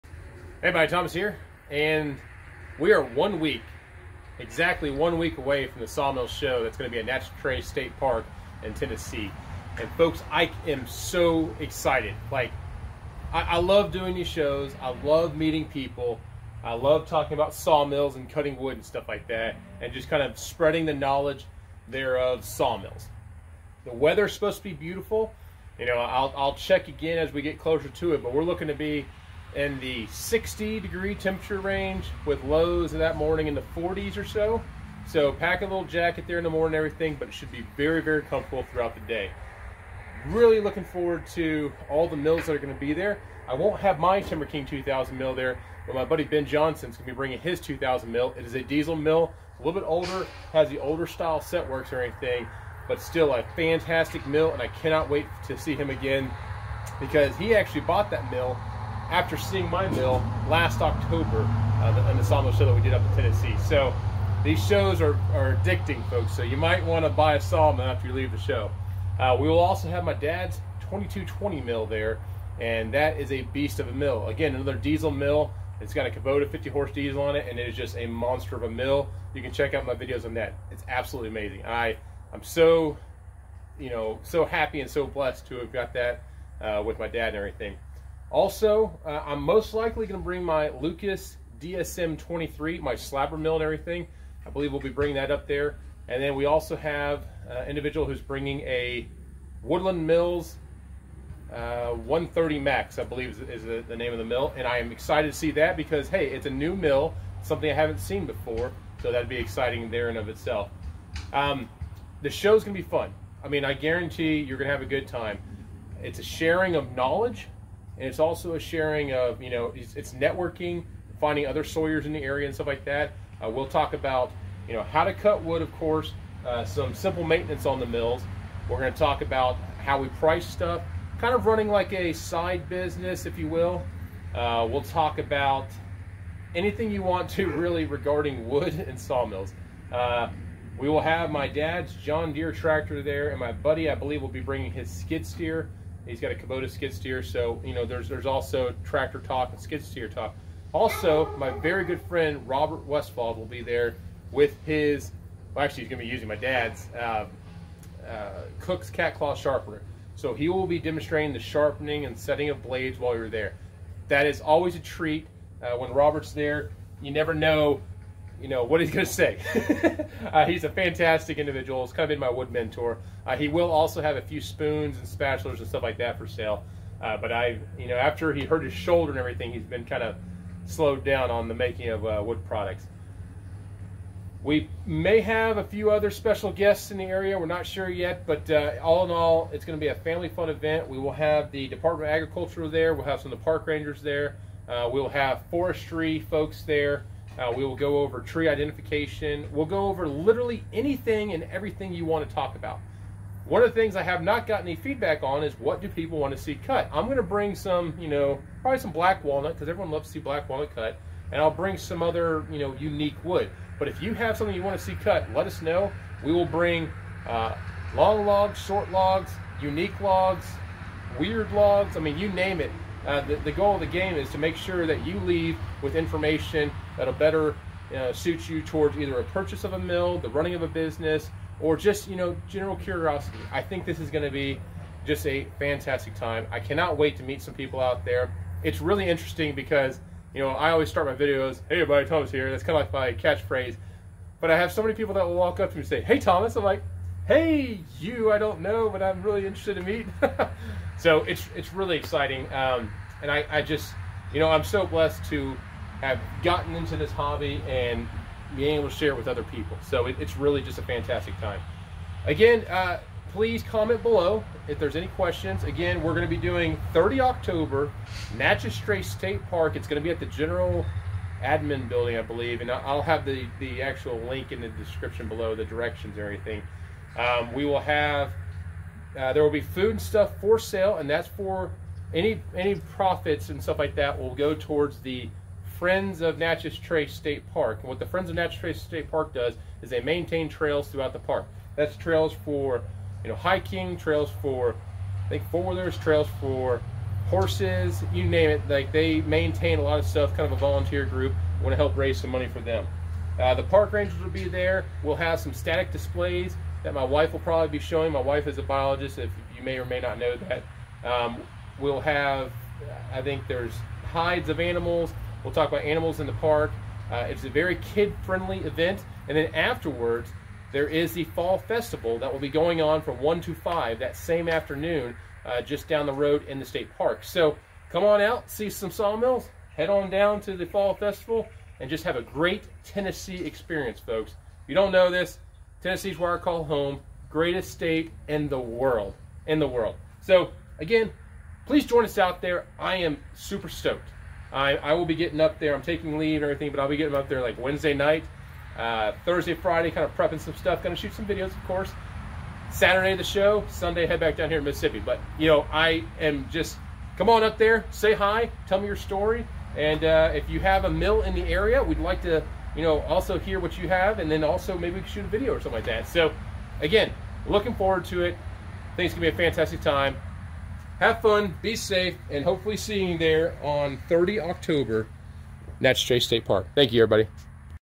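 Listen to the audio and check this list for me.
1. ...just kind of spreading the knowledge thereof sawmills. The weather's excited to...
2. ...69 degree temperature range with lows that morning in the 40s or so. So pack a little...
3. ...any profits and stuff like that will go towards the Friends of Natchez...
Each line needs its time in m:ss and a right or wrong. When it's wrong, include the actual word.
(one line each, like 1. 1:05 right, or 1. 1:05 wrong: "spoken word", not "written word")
1. 0:19 wrong: "supposed", not "excited"
2. 0:30 wrong: "60", not "69"
3. 4:42 right.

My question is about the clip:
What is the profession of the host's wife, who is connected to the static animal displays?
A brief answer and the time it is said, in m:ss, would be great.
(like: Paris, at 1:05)
Biologist, at 5:08.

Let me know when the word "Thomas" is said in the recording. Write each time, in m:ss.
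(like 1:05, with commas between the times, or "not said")
0:00, 4:02, 4:06.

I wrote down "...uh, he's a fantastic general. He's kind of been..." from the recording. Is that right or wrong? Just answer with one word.
wrong.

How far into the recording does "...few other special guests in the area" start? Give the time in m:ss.
3:05.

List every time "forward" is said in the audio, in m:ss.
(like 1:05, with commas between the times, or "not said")
0:40, 6:07.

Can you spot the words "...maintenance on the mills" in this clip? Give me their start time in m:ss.
2:07.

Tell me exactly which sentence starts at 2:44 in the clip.
That is always a treat uh, when Robert's there.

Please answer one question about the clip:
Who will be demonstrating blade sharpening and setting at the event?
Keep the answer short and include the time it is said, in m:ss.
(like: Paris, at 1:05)
Robert Westfall, at 2:32.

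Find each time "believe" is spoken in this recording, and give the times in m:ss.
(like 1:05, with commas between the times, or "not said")
1:34, 1:43, 2:23, 4:32.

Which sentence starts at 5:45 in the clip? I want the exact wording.
I'm taking leave and everything, but I'll be getting up there like Wednesday night, uh, Thursday, Friday, kind of prepping some stuff.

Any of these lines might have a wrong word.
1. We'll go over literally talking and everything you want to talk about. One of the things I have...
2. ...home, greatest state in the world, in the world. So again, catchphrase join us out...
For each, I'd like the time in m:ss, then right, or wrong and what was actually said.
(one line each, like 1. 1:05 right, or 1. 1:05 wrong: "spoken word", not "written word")
1. 3:19 wrong: "anything", not "talking"
2. 5:36 wrong: "please", not "catchphrase".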